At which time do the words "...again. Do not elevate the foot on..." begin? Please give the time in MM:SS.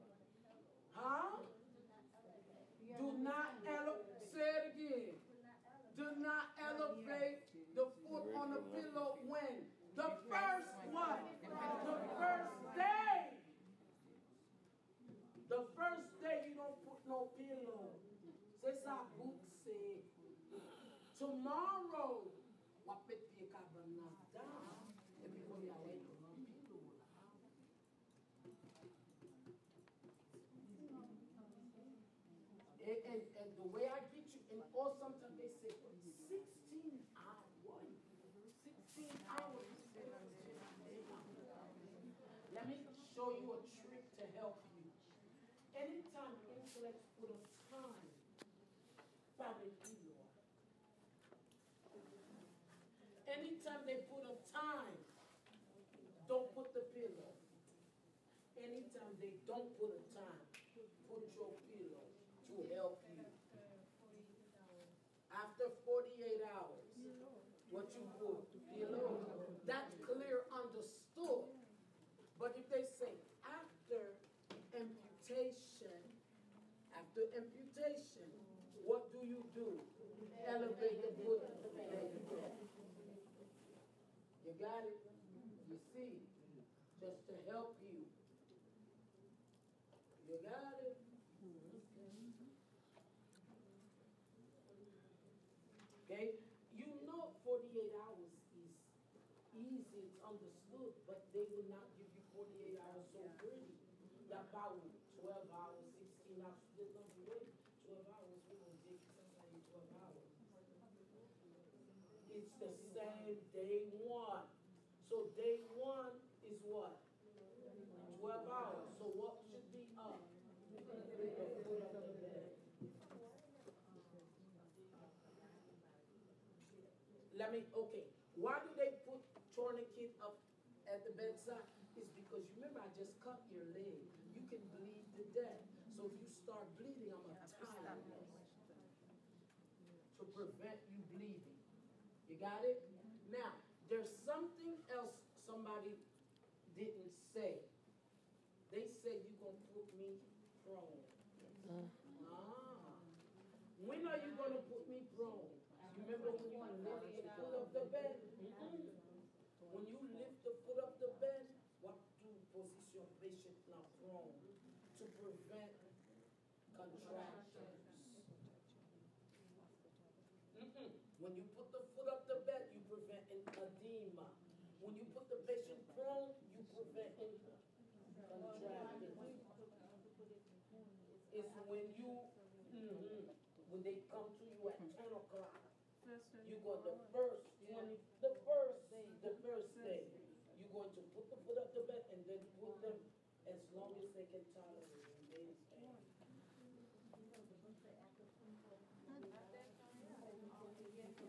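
00:04.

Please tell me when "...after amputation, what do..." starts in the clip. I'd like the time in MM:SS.
01:16.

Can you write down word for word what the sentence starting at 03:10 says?
You're going to put the foot up the bed and then put them as long as they can tolerate.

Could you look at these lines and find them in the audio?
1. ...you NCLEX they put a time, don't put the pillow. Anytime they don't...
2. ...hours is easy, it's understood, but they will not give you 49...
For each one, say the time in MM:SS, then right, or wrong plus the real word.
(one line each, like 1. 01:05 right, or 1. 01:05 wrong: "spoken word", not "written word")
1. 00:49 wrong: "Anytime", not "NCLEX"
2. 01:37 wrong: "48", not "49".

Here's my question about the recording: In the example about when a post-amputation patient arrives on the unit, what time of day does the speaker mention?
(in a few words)
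10 o'clock.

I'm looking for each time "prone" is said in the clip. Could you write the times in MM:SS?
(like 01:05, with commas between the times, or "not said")
02:30, 02:35, 02:43, 02:55.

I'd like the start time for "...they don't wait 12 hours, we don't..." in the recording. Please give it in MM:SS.
01:46.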